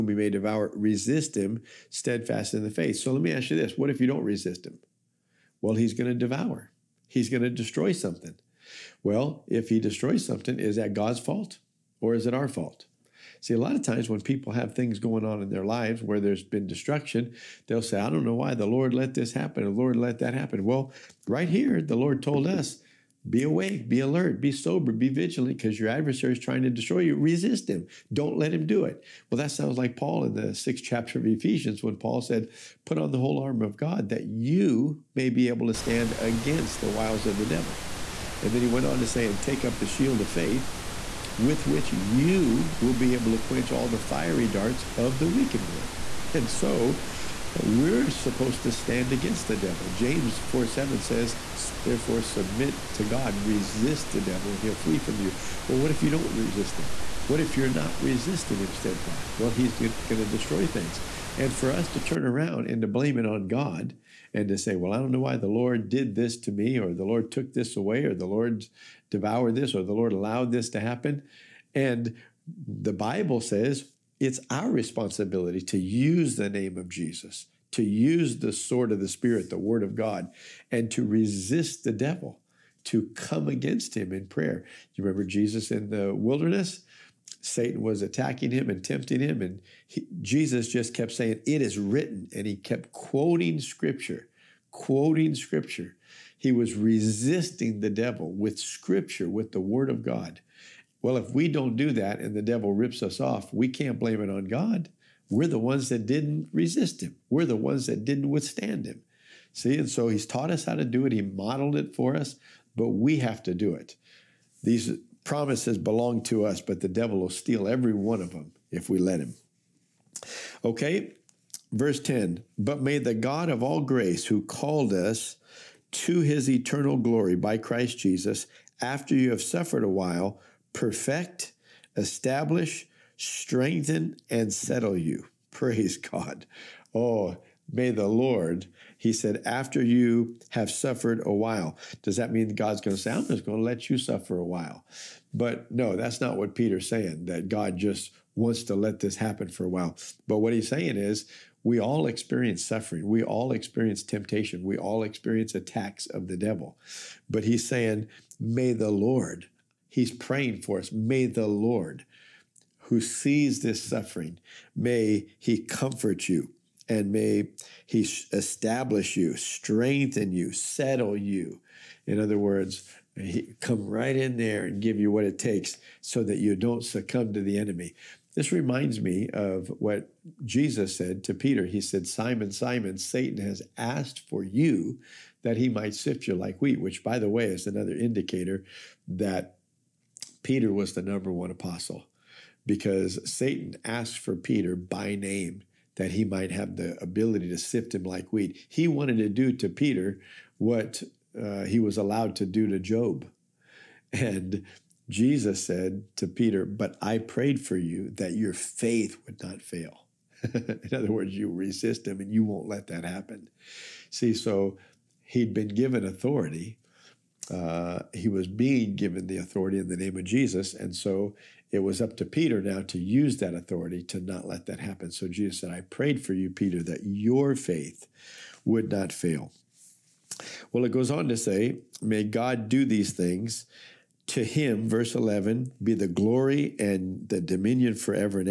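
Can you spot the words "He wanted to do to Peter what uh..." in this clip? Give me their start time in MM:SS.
03:18.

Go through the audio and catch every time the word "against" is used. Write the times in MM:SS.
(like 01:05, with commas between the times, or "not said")
00:36, 00:49, 01:23.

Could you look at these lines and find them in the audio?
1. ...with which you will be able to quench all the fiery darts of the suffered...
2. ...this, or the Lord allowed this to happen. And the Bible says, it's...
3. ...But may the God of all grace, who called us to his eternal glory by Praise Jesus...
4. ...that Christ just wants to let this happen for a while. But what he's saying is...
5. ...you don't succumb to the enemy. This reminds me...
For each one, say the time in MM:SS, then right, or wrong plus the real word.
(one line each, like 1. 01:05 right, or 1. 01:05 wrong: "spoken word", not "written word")
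1. 00:41 wrong: "wicked", not "suffered"
2. 01:09 right
3. 02:02 wrong: "Christ", not "Praise"
4. 02:27 wrong: "God", not "Christ"
5. 02:56 right.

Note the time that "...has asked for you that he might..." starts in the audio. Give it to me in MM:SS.
03:03.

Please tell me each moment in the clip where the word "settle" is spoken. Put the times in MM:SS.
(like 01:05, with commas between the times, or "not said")
02:14, 02:50.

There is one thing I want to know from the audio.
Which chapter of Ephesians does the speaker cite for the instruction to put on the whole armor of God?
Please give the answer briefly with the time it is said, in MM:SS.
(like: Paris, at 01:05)
6th chapter, at 00:30.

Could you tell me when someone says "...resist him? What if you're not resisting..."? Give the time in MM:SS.
00:56.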